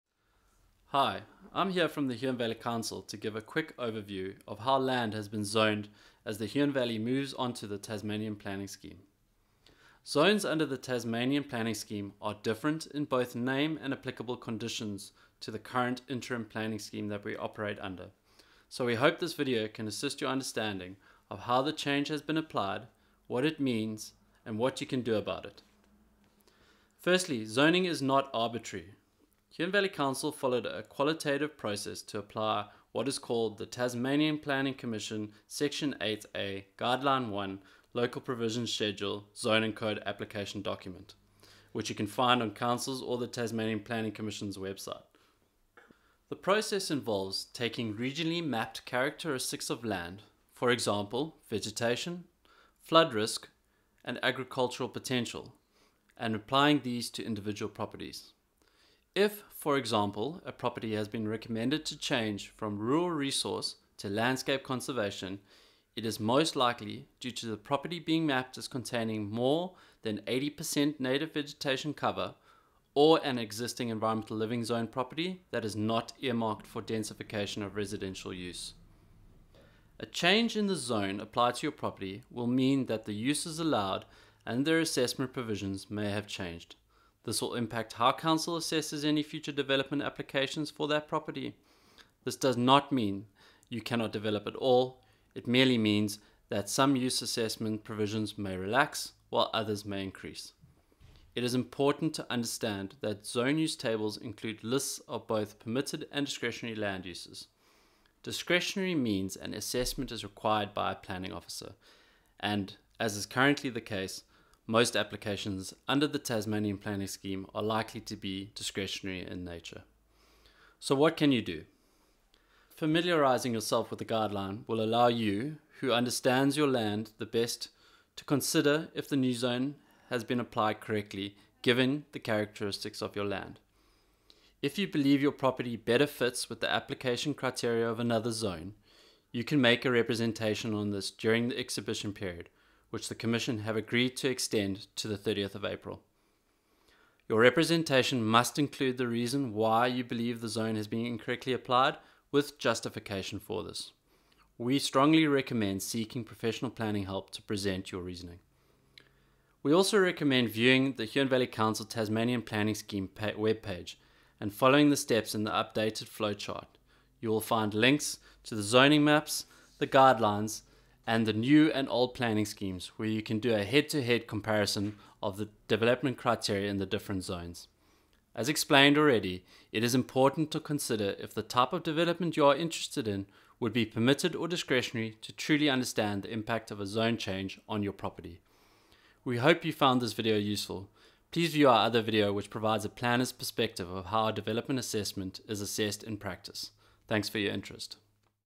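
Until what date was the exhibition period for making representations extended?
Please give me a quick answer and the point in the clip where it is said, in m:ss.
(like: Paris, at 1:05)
30 April, at 2:25.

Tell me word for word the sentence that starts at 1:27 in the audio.
This will impact how council assesses any future development applications for that property.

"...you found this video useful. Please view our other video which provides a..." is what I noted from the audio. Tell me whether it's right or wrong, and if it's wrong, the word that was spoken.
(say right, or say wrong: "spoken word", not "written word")
right.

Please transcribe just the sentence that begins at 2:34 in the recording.
We strongly recommend seeking professional planning help to present your reasoning.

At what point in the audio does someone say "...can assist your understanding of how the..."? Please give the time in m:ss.
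0:19.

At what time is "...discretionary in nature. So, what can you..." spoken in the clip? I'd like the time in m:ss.
1:58.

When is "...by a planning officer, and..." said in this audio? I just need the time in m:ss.
1:50.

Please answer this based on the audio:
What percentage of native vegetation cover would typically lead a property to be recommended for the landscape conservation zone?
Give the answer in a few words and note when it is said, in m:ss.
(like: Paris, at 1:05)
80%, at 1:10.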